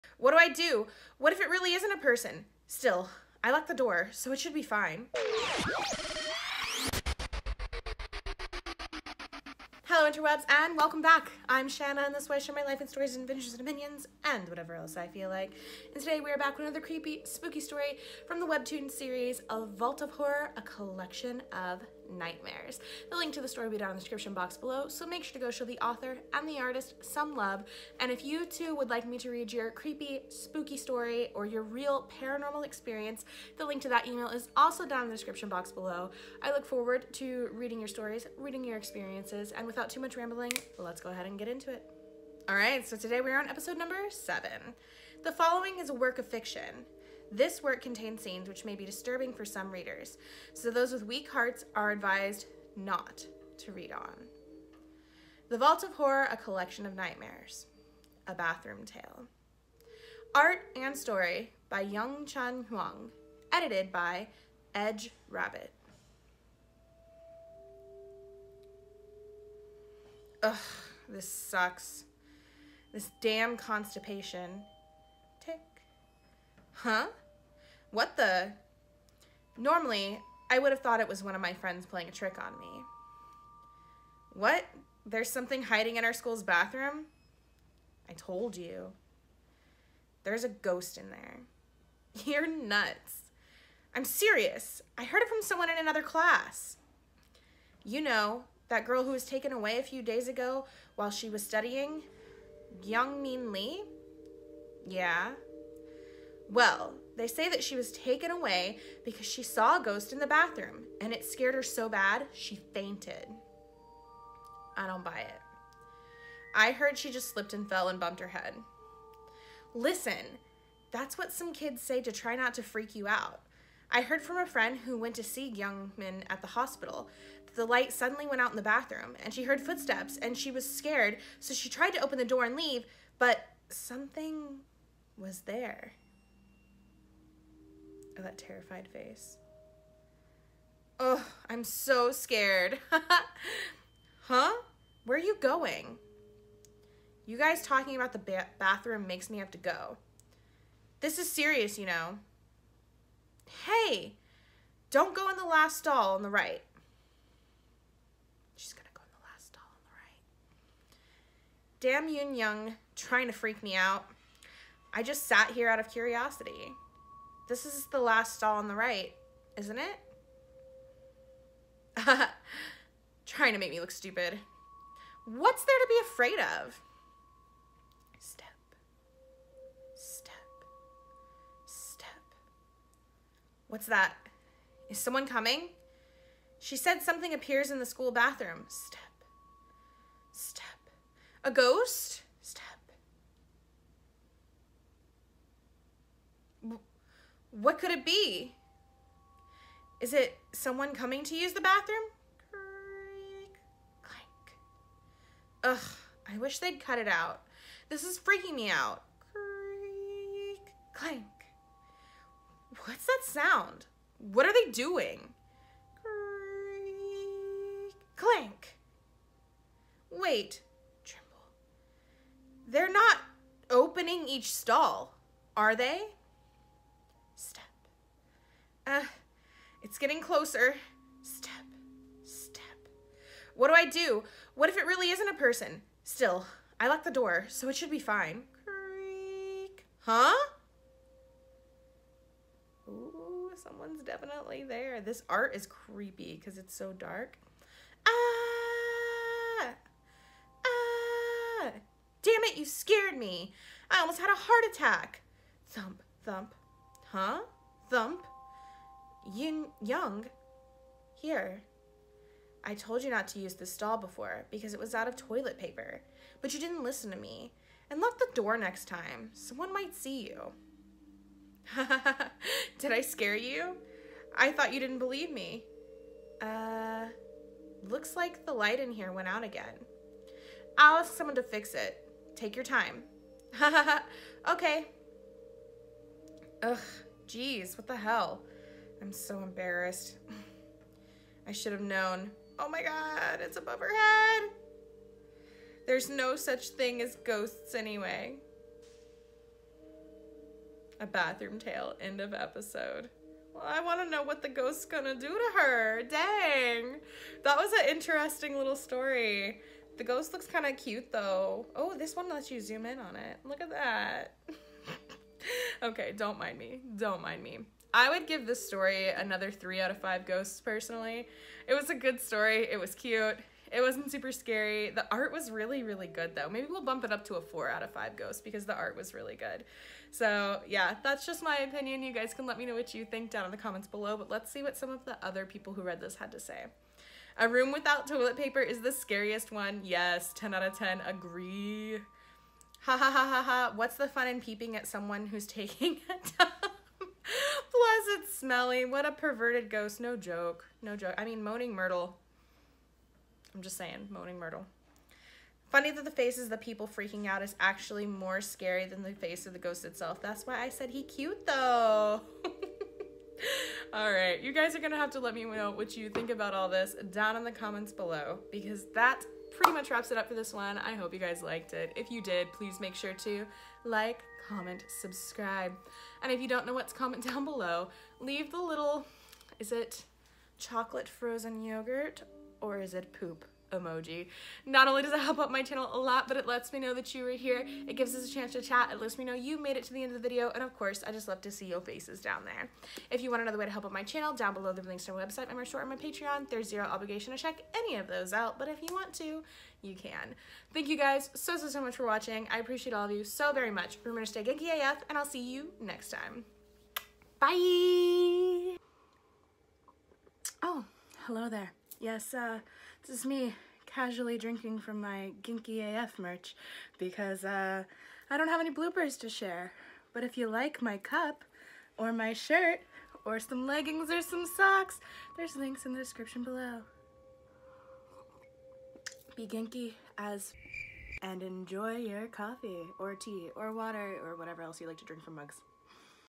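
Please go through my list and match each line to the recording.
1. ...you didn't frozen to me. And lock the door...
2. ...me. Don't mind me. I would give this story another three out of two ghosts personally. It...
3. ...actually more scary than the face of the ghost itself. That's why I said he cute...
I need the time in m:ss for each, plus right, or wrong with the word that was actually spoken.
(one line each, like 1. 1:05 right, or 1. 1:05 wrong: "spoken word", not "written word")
1. 4:26 wrong: "listen", not "frozen"
2. 5:16 wrong: "five", not "two"
3. 5:57 right.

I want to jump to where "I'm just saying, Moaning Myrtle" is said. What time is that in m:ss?
5:53.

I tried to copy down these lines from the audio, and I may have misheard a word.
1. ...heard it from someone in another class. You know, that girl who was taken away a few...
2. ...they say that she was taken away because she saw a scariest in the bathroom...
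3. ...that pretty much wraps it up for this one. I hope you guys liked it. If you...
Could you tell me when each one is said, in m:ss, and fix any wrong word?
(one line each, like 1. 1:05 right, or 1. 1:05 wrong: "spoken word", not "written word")
1. 1:35 right
2. 1:47 wrong: "ghost", not "scariest"
3. 6:08 right.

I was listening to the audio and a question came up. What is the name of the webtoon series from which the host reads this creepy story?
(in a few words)
A Vault of Horror.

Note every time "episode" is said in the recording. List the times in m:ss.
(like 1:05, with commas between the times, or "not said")
0:43, 5:02.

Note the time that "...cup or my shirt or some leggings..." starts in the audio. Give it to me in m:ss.
7:00.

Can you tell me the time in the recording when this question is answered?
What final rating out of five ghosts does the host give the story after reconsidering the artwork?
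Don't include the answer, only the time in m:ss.
5:27.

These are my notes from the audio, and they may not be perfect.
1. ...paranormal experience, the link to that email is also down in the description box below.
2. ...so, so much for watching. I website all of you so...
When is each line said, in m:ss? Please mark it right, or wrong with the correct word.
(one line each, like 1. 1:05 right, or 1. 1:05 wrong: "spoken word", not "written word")
1. 0:32 right
2. 6:41 wrong: "appreciate", not "website".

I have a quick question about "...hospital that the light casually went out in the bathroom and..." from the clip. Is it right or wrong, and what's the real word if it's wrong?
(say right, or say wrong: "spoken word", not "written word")
wrong: "suddenly", not "casually".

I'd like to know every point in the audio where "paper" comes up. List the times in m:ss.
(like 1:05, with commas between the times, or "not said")
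4:25, 5:38.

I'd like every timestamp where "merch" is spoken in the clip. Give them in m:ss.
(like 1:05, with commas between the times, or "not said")
6:35, 6:56.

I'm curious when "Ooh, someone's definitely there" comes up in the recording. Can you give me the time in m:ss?
4:02.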